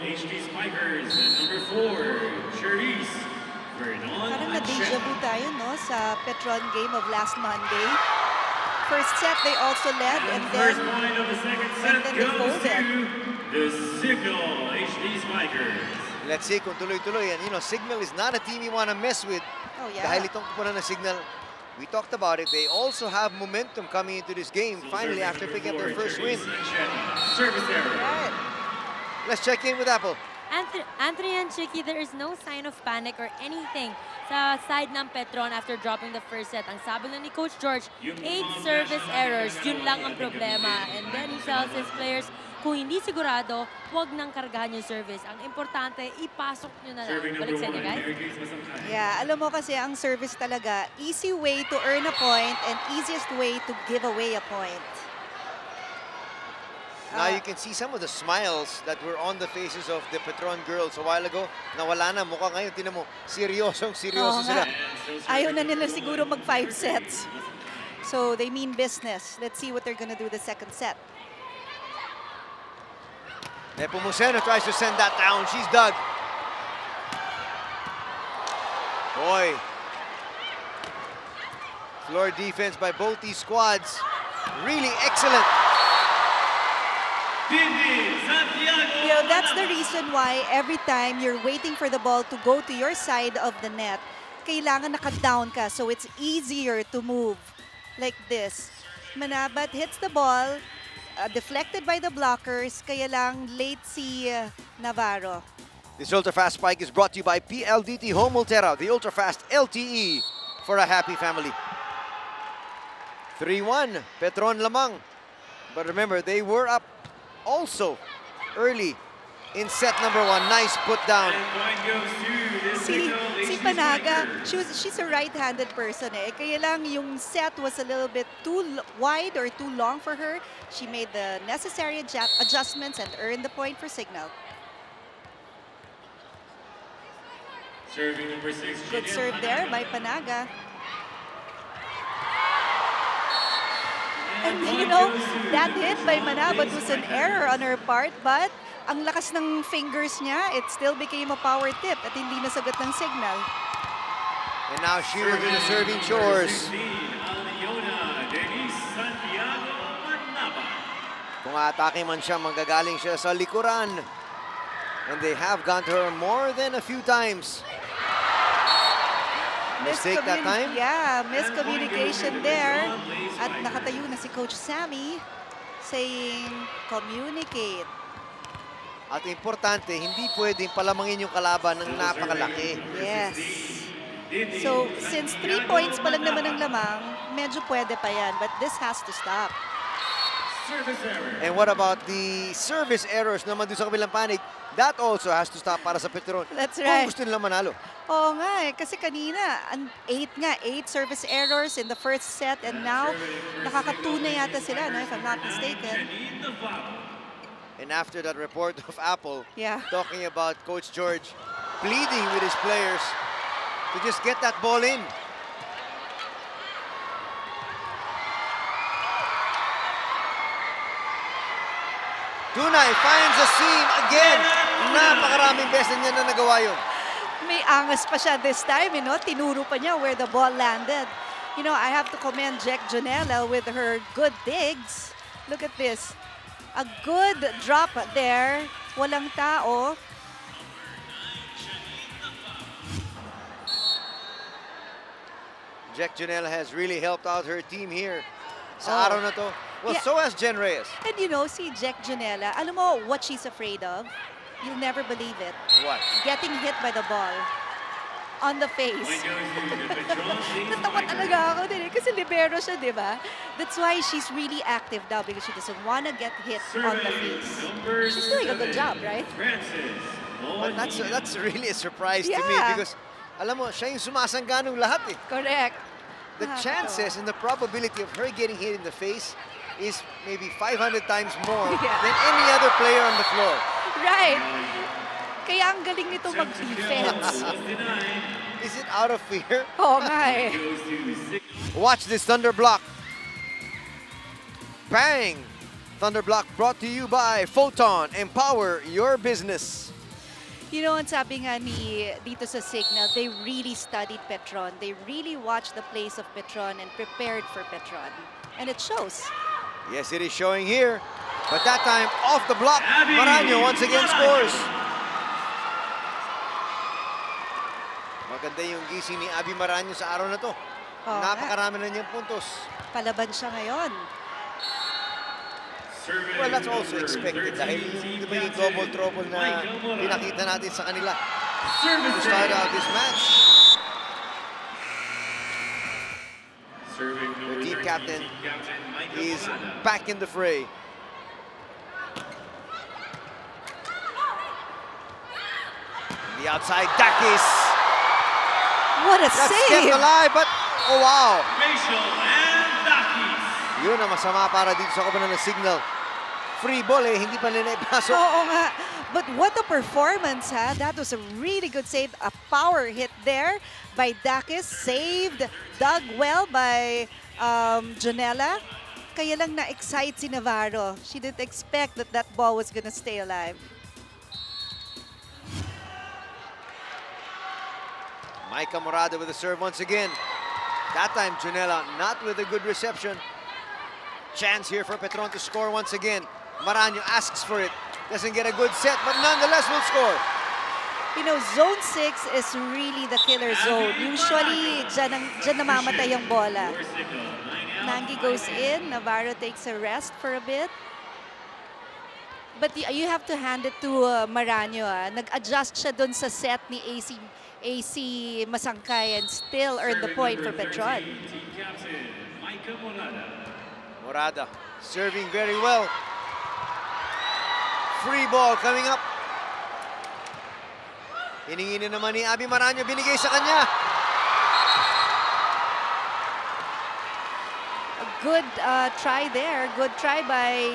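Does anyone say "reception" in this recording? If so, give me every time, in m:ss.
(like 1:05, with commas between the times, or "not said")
6:22.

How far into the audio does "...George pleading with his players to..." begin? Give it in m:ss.
3:30.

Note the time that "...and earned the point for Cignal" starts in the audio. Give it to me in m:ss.
2:12.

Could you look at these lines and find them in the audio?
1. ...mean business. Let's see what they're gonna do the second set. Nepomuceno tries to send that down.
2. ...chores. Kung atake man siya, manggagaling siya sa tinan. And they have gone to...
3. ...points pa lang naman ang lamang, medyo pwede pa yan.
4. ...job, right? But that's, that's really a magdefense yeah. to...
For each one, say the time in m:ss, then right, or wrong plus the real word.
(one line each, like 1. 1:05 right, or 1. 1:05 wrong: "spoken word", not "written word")
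1. 1:08 right
2. 2:36 wrong: "likuran", not "tinan"
3. 3:05 right
4. 4:28 wrong: "surprise", not "magdefense".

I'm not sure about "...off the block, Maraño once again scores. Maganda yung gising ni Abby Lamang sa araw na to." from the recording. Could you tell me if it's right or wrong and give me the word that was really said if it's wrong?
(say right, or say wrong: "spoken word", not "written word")
wrong: "Maraño", not "Lamang".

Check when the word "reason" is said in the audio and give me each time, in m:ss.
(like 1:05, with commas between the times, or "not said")
1:29.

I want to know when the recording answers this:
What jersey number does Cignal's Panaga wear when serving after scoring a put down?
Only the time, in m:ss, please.
2:18.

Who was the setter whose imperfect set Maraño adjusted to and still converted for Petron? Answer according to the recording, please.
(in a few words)
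AC Masangkay.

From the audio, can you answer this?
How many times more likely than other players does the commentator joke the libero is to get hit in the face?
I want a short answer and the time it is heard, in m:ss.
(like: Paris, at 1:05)
500, at 4:40.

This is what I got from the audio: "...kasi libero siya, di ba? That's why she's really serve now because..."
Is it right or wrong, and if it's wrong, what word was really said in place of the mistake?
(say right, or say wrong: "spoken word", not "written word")
wrong: "active", not "serve".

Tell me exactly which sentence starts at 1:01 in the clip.
Nawala na, mukha ngayon, tinan mo, seryosong seryoso sila.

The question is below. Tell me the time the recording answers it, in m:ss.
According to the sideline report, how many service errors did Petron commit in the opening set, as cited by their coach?
0:38.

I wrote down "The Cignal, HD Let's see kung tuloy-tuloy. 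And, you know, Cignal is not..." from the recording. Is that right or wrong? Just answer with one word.
right.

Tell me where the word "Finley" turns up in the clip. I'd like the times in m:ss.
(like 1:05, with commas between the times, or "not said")
not said.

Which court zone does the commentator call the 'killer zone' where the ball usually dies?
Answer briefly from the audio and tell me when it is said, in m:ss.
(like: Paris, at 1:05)
zone 6, at 6:31.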